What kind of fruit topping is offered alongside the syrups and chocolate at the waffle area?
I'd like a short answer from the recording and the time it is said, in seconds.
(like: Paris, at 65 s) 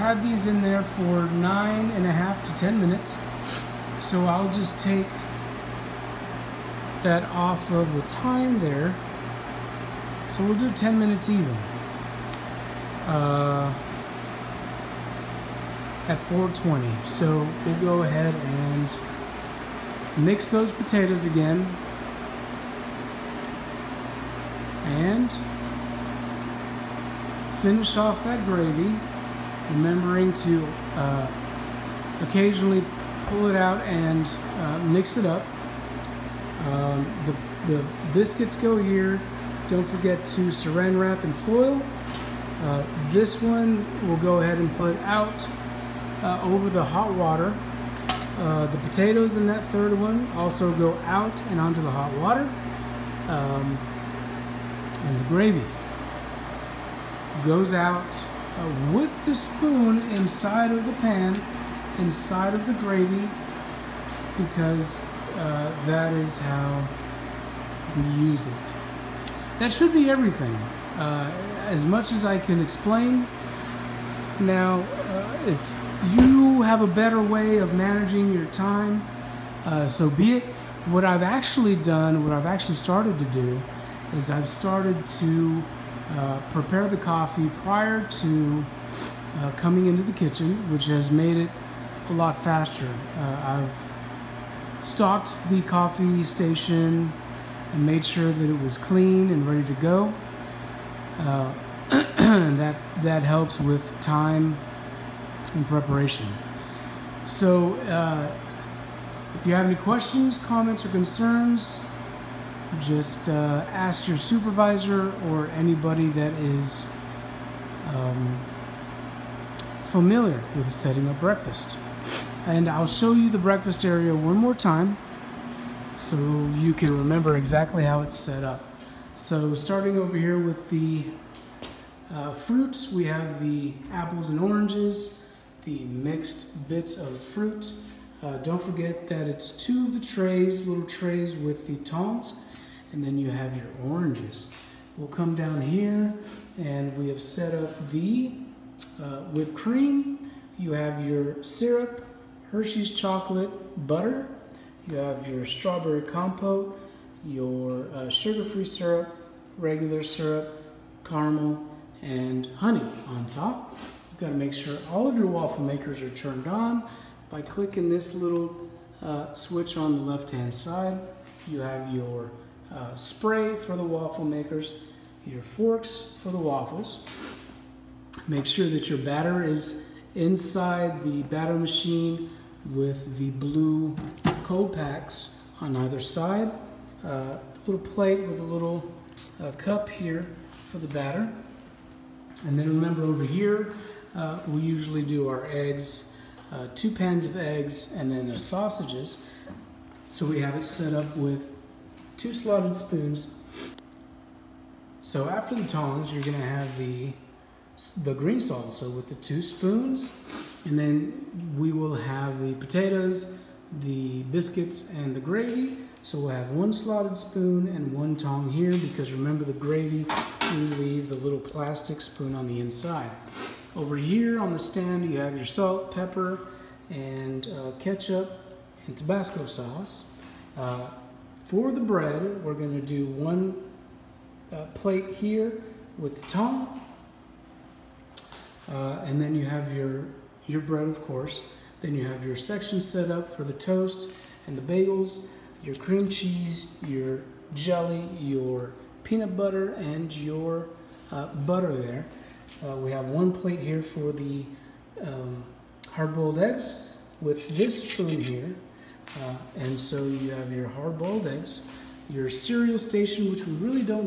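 strawberry compote, at 155 s.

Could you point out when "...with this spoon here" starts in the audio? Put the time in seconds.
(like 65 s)
257 s.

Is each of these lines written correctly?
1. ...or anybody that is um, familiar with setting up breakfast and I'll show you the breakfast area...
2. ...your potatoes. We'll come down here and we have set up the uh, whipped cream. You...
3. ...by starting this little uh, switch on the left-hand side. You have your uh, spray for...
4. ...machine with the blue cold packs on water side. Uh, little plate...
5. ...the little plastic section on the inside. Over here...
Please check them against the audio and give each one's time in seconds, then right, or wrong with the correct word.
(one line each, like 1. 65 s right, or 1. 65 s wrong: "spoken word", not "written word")
1. 115 s right
2. 143 s wrong: "oranges", not "potatoes"
3. 167 s wrong: "clicking", not "starting"
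4. 181 s wrong: "either", not "water"
5. 221 s wrong: "spoon", not "section".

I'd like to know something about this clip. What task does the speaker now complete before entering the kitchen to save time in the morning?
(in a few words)
prepare the coffee.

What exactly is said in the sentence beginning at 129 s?
So starting over here with the uh, fruits, we have the apples and oranges, the mixed bits of fruit.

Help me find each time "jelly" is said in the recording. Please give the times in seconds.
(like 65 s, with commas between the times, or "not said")
247 s.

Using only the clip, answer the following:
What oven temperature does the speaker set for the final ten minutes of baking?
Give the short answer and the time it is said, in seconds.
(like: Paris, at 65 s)
420, at 16 s.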